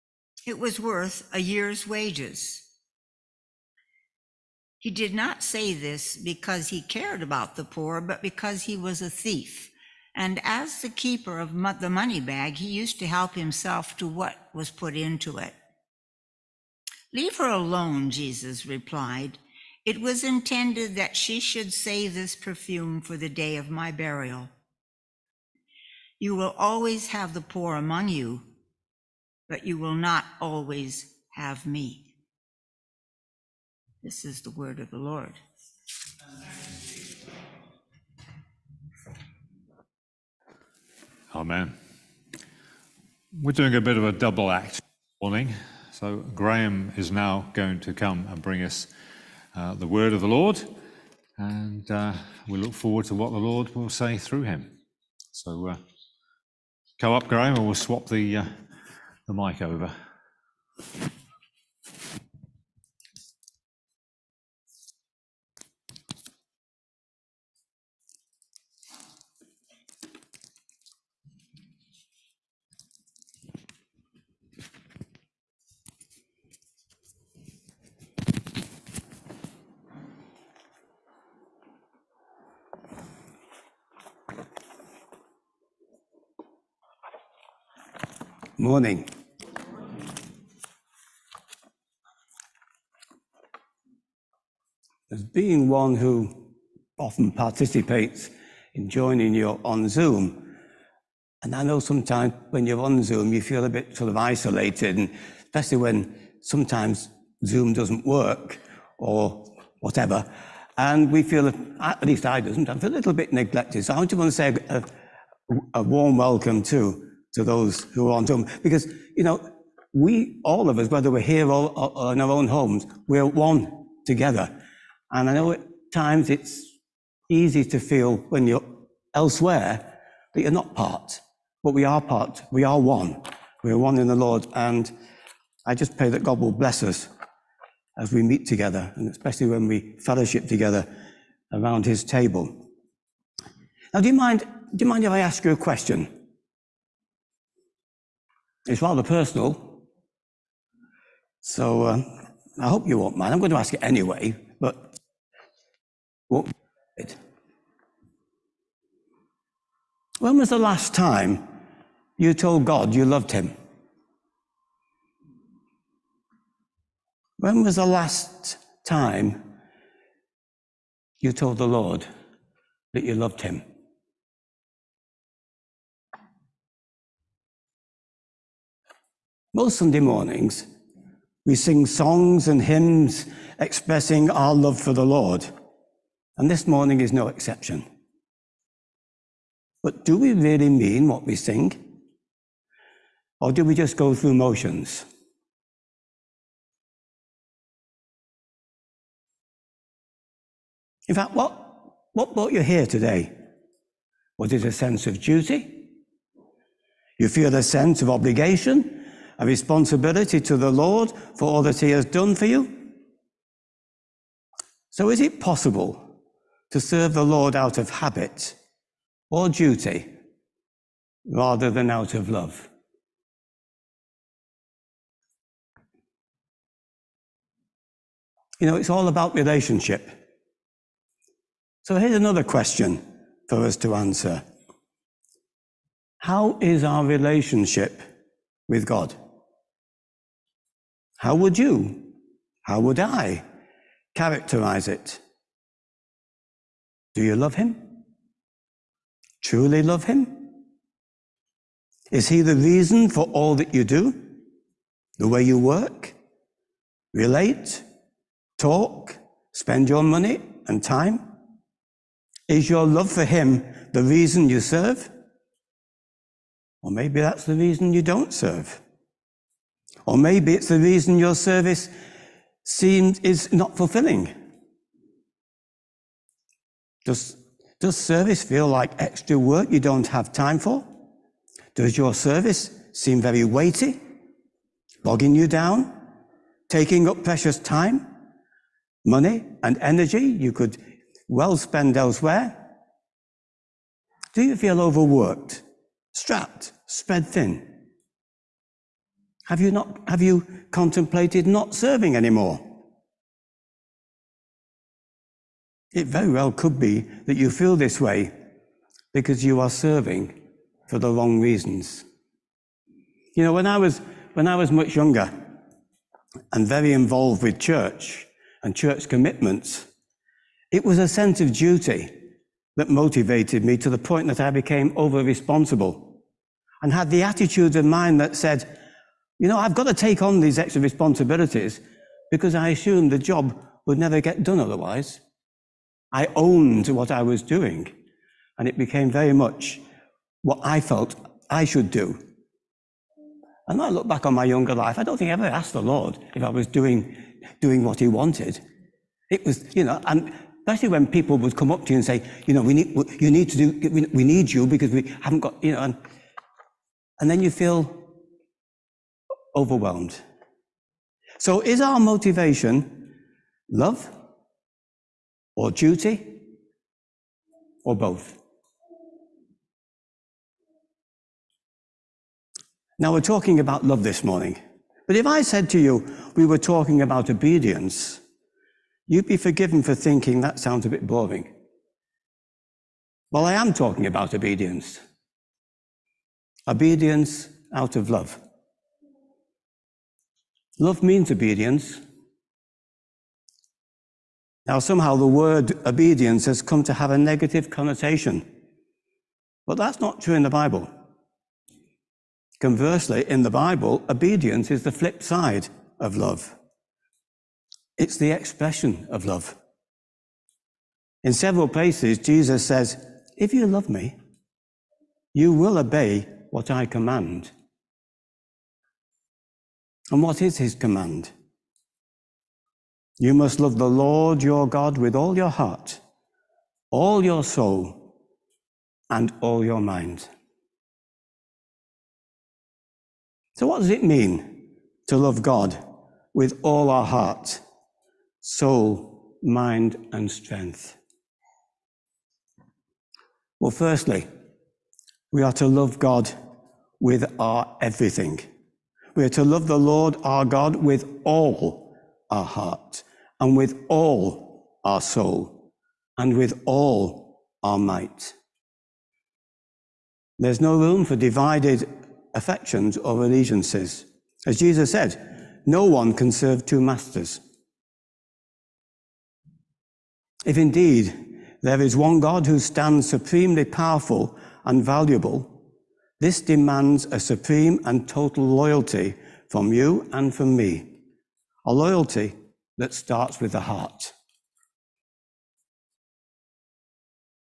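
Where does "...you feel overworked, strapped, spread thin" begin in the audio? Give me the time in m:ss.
4:54.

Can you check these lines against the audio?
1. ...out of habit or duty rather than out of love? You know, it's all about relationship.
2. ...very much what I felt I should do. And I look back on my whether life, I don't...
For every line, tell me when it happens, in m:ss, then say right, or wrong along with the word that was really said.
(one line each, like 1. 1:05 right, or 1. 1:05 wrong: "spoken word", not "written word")
1. 3:37 right
2. 5:39 wrong: "younger", not "whether".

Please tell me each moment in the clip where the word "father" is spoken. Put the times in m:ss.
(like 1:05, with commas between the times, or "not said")
not said.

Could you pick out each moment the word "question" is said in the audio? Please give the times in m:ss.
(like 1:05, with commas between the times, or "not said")
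2:25, 3:52.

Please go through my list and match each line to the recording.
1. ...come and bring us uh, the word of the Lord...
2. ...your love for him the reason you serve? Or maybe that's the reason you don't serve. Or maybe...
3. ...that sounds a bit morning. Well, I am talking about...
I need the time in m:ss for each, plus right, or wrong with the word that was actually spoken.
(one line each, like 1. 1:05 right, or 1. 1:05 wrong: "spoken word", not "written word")
1. 0:47 right
2. 4:22 right
3. 6:20 wrong: "boring", not "morning".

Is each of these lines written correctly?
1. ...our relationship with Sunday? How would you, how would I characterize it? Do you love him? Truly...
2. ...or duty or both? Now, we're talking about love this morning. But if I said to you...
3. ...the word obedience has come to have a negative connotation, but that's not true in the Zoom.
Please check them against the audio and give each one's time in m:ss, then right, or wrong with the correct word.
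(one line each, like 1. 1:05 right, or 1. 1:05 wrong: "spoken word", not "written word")
1. 3:56 wrong: "God", not "Sunday"
2. 6:05 right
3. 6:35 wrong: "Bible", not "Zoom".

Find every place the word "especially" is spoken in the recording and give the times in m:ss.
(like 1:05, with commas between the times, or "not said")
1:45, 2:19, 5:50.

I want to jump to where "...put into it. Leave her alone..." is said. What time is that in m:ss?
0:14.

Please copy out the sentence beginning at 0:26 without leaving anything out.
You will always have the poor among you, but you will not always have me.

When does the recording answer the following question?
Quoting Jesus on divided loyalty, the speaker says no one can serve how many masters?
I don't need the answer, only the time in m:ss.
7:46.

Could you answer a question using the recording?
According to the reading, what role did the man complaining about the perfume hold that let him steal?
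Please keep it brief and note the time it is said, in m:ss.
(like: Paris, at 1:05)
Keeper of the money bag, at 0:10.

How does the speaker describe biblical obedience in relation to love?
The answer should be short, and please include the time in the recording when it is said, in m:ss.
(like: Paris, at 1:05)
The flip side, at 6:44.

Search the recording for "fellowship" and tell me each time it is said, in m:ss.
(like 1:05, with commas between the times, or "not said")
2:19.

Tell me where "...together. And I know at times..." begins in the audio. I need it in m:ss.
2:04.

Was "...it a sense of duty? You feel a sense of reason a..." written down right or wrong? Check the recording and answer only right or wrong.
wrong.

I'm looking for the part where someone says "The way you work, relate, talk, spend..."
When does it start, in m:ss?
4:15.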